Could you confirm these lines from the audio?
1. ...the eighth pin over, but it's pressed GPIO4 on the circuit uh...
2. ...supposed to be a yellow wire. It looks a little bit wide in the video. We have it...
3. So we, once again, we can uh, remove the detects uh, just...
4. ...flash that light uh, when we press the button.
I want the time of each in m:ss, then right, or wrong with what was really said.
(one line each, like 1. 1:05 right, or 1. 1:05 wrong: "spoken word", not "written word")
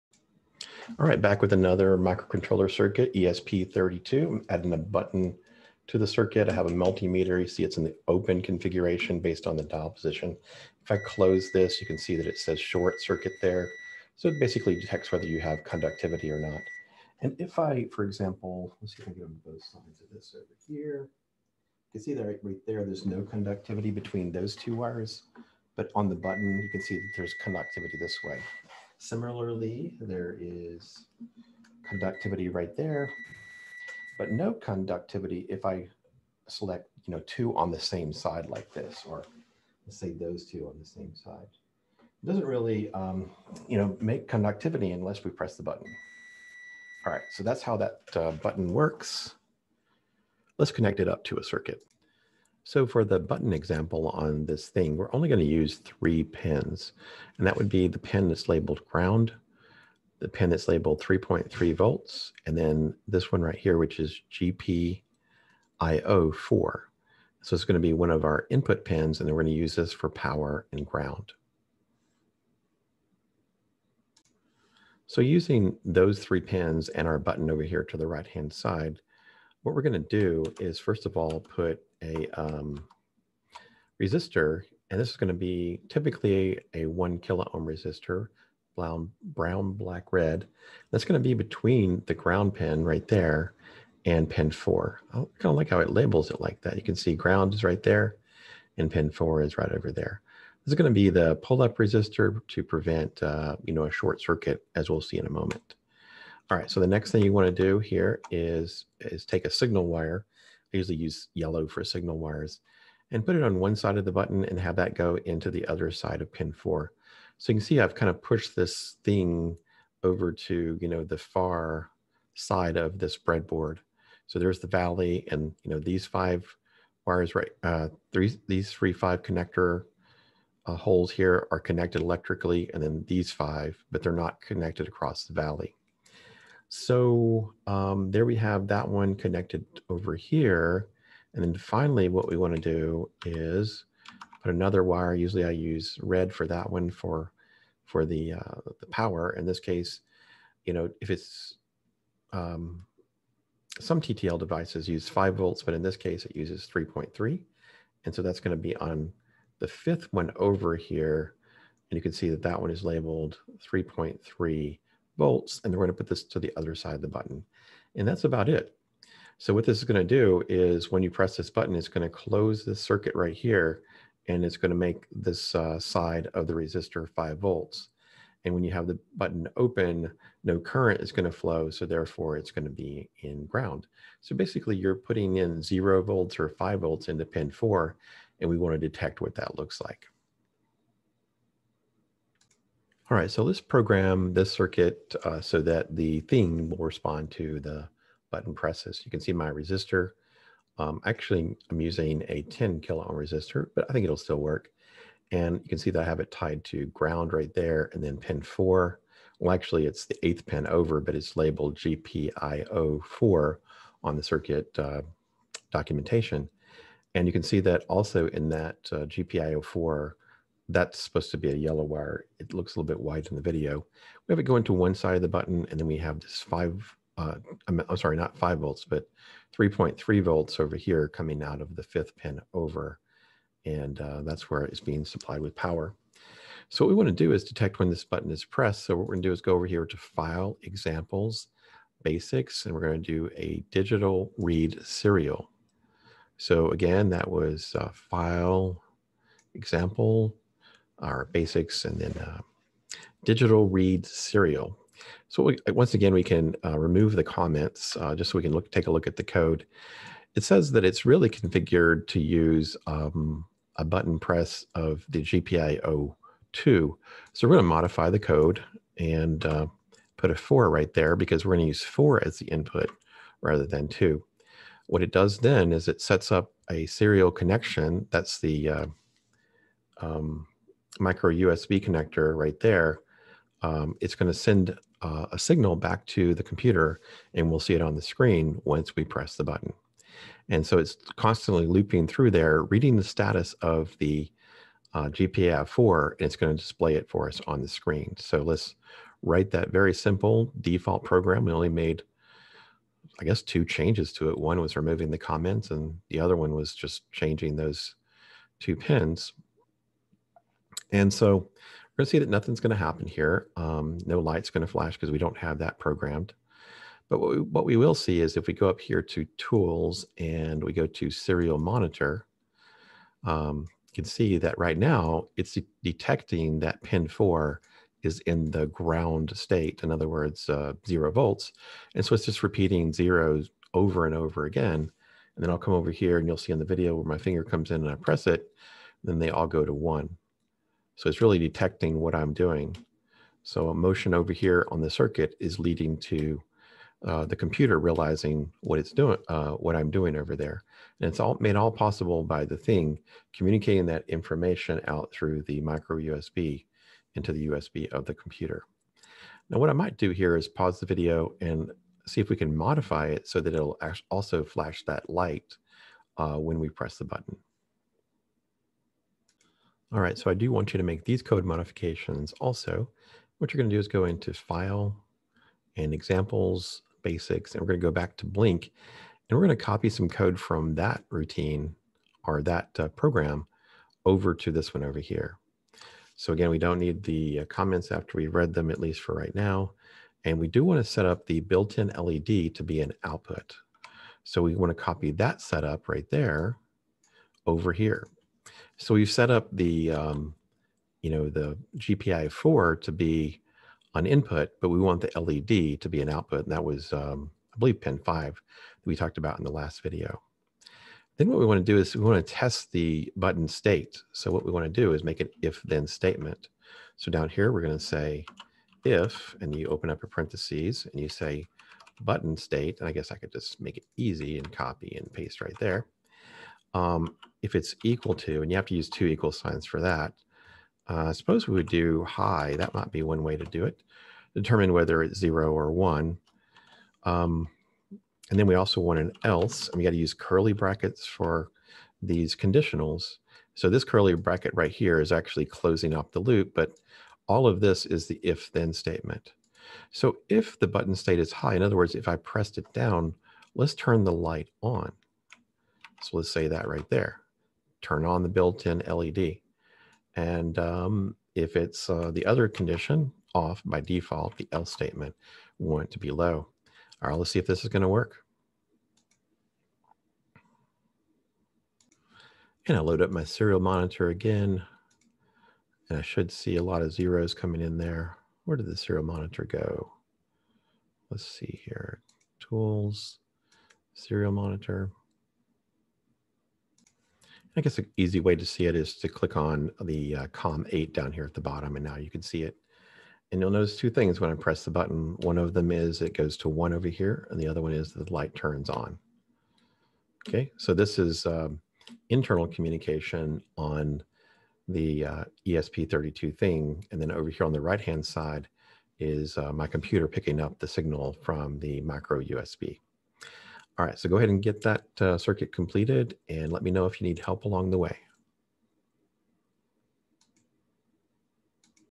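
1. 3:30 wrong: "labeled", not "pressed"
2. 3:40 right
3. 4:15 wrong: "comments", not "detects"
4. 6:04 right.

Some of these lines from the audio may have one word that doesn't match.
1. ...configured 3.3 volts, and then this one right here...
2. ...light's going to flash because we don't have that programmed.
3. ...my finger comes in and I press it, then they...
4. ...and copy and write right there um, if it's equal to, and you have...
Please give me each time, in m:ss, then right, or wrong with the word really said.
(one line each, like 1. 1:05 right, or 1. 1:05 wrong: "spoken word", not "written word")
1. 1:00 wrong: "labeled", not "configured"
2. 5:14 right
3. 5:37 right
4. 7:04 wrong: "paste", not "write".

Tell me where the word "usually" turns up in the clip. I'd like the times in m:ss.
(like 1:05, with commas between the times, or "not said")
1:50, 2:25.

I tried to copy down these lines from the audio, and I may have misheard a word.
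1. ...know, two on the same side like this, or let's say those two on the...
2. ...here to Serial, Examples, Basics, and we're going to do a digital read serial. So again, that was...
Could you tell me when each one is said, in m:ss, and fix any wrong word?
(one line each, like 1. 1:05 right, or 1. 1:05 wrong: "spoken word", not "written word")
1. 0:37 right
2. 3:59 wrong: "File", not "Serial".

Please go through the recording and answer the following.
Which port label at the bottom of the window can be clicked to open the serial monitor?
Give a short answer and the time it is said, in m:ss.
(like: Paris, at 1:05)
COM8, at 8:10.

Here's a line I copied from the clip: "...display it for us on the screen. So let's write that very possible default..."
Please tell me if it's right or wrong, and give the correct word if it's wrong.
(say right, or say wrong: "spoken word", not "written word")
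wrong: "simple", not "possible".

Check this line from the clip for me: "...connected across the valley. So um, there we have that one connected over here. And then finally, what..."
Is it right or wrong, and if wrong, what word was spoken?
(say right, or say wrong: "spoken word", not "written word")
right.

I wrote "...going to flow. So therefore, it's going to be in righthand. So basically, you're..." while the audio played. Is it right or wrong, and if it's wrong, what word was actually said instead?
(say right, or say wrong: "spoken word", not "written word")
wrong: "ground", not "righthand".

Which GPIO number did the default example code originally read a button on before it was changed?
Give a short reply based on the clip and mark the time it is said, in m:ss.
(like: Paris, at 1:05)
2, at 4:25.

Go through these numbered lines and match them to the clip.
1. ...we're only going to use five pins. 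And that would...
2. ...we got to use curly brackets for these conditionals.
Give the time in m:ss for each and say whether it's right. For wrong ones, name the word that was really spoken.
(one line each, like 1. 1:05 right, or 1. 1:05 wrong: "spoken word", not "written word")
1. 0:54 wrong: "three", not "five"
2. 7:19 right.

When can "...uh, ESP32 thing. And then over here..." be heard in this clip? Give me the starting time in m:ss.
8:25.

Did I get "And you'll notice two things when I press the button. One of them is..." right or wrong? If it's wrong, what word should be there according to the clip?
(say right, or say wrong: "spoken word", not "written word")
right.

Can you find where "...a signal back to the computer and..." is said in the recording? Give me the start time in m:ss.
4:45.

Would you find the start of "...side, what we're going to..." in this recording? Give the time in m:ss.
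1:18.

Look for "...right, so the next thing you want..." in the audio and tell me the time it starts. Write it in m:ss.
1:46.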